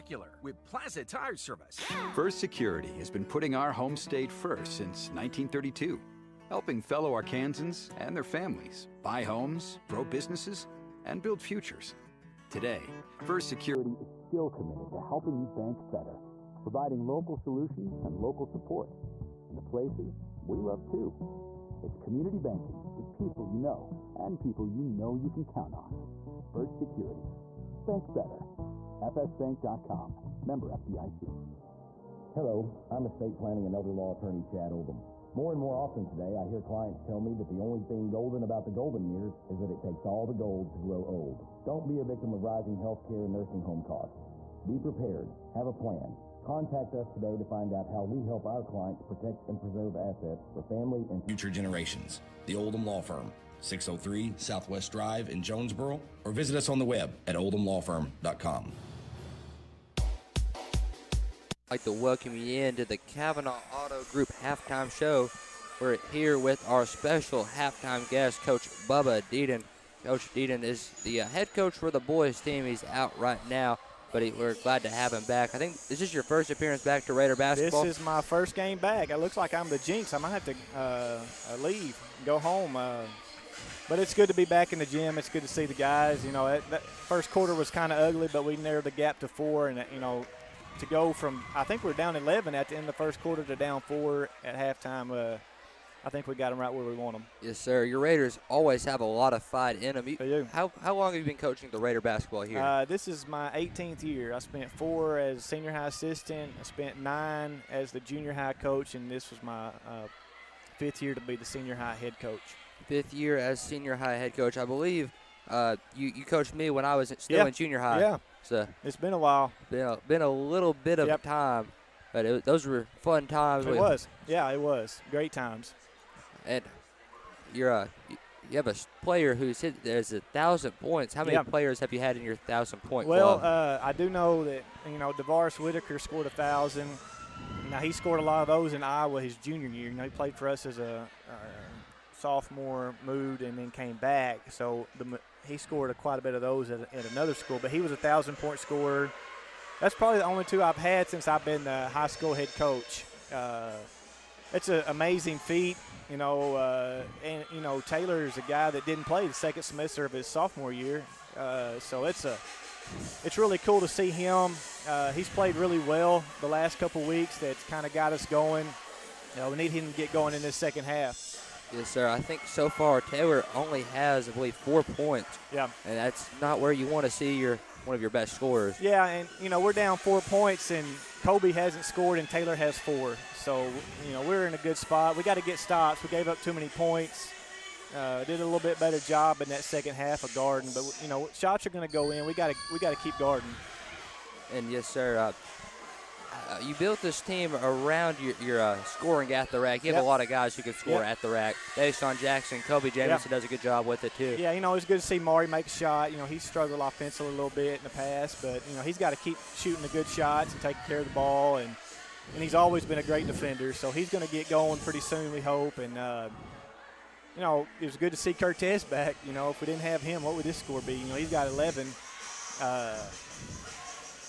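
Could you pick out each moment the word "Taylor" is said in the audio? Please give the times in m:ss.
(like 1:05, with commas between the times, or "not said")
2:53, 3:02.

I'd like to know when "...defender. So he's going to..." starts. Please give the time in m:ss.
3:33.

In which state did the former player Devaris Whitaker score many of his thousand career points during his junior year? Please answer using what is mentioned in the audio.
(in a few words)
Iowa.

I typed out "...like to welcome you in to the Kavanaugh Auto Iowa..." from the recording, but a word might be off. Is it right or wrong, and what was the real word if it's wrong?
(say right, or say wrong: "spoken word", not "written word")
wrong: "Group", not "Iowa".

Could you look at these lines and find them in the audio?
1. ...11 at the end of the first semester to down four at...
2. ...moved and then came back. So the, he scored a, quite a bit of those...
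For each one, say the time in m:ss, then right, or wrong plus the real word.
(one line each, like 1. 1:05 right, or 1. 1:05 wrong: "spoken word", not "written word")
1. 1:32 wrong: "quarter", not "semester"
2. 2:23 right.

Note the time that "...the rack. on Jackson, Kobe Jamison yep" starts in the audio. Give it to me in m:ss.
3:21.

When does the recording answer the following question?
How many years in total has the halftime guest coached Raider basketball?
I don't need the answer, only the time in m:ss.
1:43.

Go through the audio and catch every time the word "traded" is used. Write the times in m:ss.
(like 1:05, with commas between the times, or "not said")
not said.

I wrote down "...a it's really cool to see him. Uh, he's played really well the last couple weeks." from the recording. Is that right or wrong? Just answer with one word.
right.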